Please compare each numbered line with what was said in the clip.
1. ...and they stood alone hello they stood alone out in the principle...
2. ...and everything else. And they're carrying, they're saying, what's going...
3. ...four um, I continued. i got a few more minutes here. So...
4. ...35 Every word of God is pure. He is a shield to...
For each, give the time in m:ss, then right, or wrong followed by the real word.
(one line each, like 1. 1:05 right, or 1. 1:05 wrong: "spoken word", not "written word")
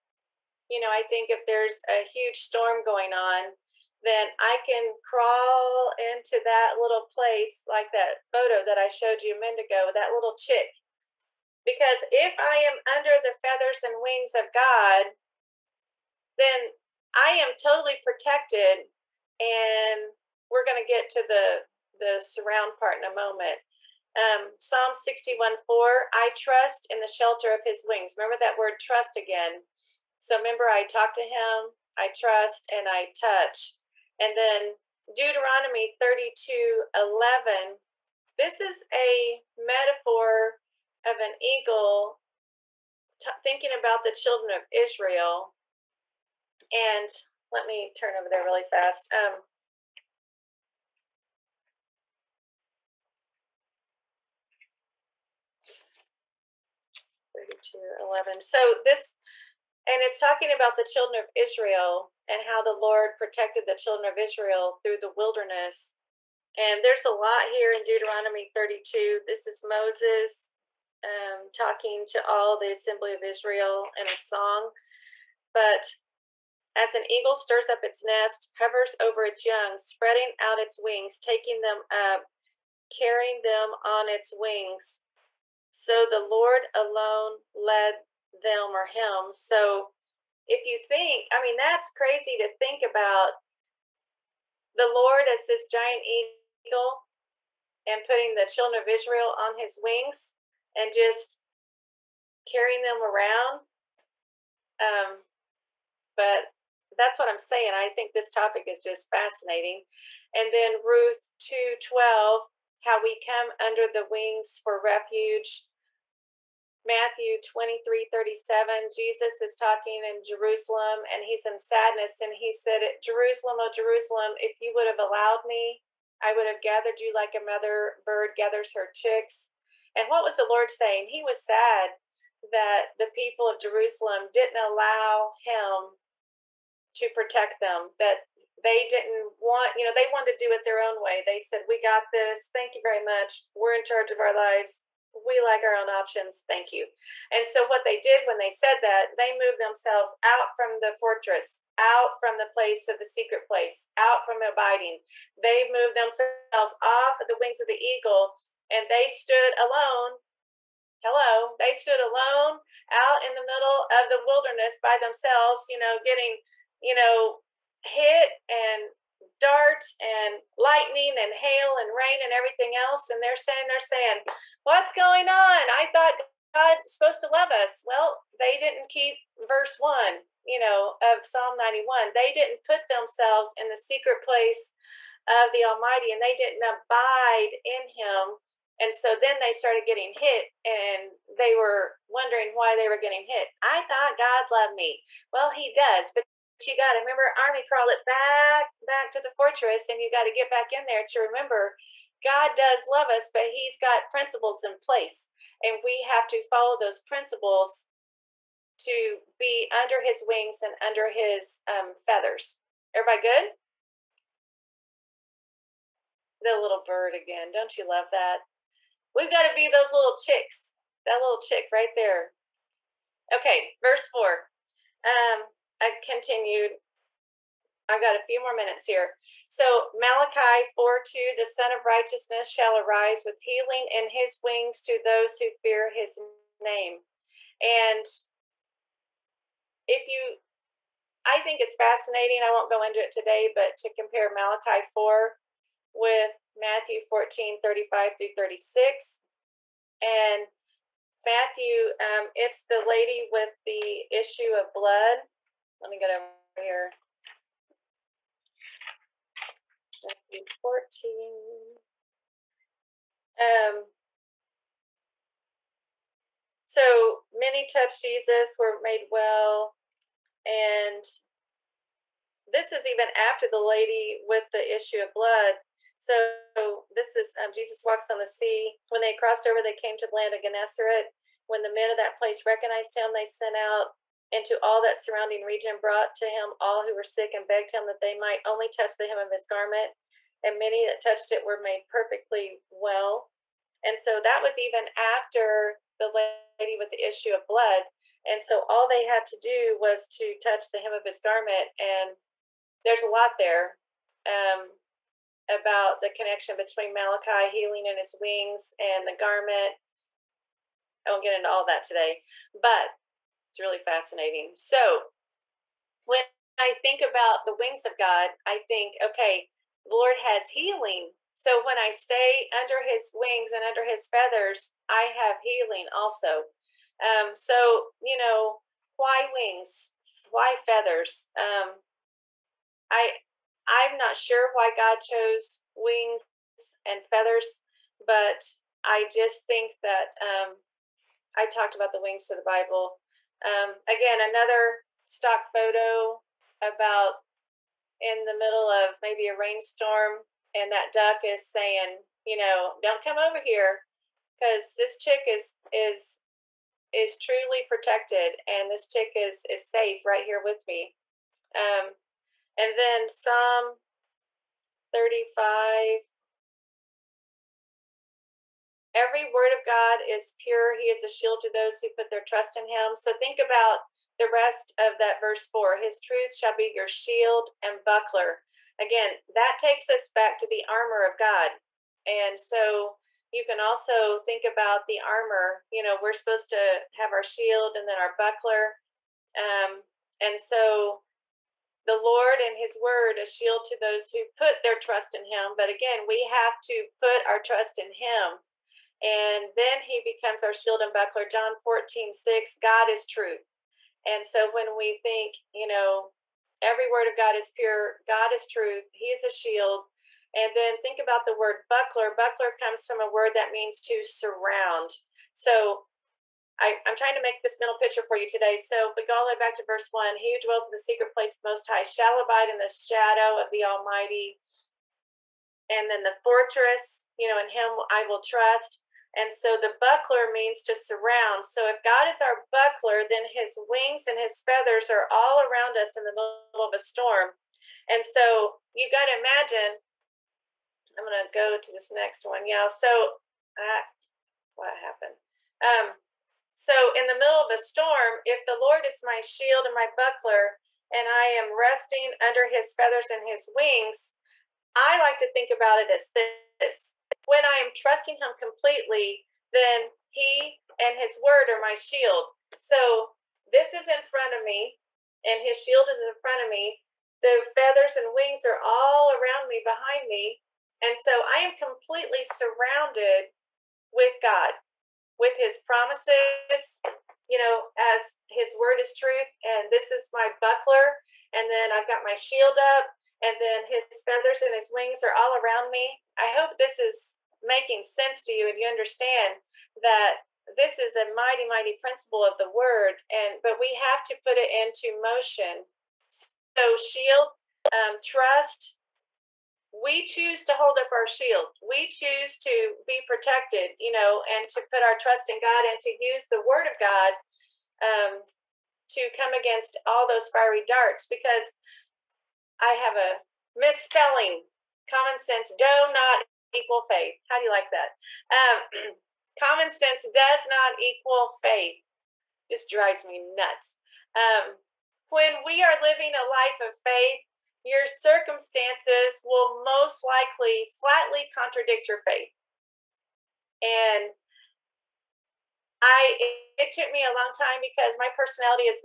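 1. 2:38 wrong: "middle", not "principle"
2. 2:52 wrong: "saying", not "carrying"
3. 3:44 right
4. 6:04 right.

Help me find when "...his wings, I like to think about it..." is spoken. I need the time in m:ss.
7:33.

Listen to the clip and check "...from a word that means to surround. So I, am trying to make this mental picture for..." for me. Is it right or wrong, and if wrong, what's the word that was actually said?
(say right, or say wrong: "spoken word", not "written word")
right.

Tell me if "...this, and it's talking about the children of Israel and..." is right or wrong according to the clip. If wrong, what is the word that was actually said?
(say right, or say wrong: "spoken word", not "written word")
right.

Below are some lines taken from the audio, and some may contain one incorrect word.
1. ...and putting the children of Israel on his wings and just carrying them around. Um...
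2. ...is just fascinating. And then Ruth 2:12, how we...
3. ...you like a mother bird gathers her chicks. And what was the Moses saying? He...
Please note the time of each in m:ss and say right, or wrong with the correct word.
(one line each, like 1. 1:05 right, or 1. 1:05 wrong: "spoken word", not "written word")
1. 1:37 right
2. 1:48 right
3. 2:06 wrong: "Lord", not "Moses".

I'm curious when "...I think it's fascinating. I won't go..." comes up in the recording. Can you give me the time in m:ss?
4:01.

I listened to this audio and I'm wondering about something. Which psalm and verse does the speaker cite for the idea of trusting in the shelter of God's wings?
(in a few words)
Psalm 61:4.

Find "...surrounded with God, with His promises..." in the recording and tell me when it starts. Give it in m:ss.
7:52.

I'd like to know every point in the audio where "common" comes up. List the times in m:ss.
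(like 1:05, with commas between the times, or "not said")
8:34, 8:39.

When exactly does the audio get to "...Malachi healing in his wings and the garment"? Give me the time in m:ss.
5:06.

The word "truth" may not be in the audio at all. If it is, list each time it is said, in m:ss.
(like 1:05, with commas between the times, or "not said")
6:16, 6:43, 6:48, 7:58.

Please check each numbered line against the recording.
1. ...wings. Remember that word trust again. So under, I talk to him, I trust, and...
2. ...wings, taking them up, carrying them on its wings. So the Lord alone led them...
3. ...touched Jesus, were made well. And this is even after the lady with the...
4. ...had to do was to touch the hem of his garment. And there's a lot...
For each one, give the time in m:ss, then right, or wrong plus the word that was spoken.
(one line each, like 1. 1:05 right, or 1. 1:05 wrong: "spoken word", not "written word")
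1. 0:27 wrong: "remember", not "under"
2. 1:20 right
3. 4:27 right
4. 4:59 right.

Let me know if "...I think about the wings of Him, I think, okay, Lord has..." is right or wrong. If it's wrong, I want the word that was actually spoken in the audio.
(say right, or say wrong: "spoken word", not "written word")
wrong: "God", not "Him".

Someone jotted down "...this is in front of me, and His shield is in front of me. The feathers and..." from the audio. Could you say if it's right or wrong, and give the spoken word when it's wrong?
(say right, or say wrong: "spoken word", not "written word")
right.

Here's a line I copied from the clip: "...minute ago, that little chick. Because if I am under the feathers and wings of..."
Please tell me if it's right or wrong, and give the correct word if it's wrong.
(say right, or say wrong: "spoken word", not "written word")
right.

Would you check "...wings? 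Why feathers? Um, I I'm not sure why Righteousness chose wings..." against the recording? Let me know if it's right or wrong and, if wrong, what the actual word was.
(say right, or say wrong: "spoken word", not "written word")
wrong: "God", not "Righteousness".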